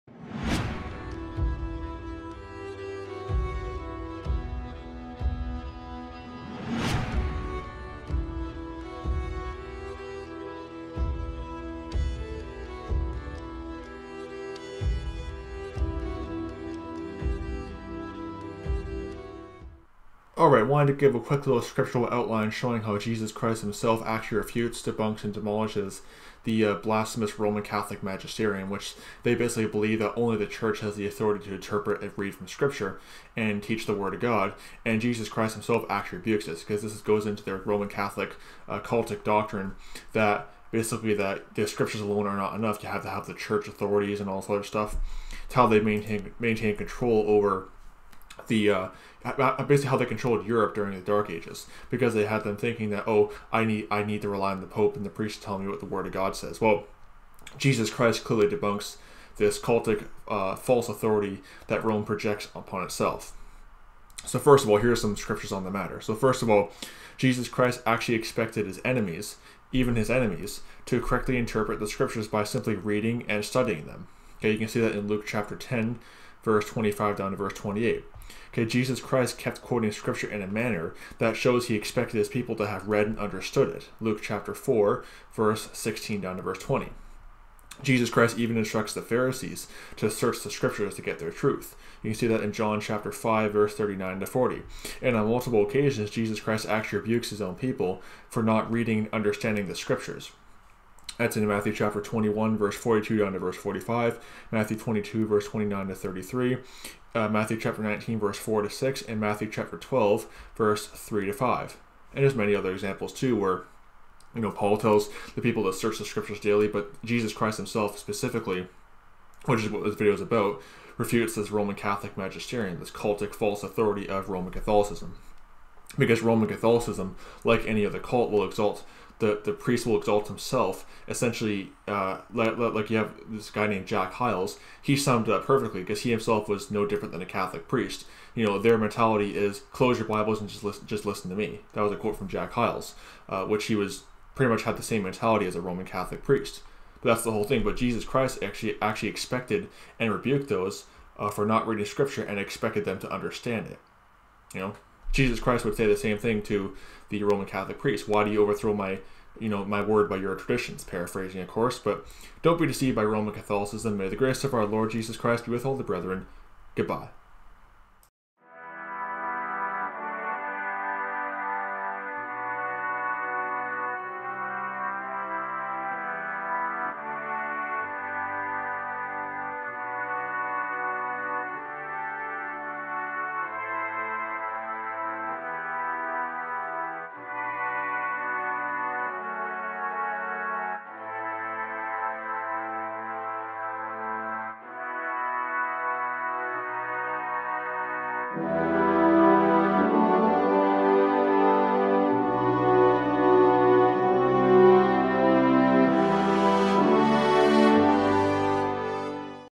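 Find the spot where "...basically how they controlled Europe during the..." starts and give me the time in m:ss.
0:49.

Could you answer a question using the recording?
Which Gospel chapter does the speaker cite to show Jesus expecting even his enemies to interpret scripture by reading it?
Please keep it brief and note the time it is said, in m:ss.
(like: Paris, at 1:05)
Luke 10, at 1:15.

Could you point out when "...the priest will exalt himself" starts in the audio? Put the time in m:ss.
2:09.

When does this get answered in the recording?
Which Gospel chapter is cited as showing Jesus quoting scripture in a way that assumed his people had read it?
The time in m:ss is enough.
1:23.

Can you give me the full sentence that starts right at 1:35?
And on multiple occasions, Jesus Christ actually rebukes his own people for not reading and understanding the scriptures.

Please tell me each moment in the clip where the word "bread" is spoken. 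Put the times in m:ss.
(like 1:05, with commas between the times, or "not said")
not said.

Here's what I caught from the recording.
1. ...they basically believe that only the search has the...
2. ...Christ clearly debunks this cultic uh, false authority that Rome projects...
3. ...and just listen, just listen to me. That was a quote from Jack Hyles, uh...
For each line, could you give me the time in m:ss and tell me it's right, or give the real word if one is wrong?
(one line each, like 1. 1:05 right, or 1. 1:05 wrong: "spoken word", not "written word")
1. 0:29 wrong: "church", not "search"
2. 0:57 right
3. 2:20 right.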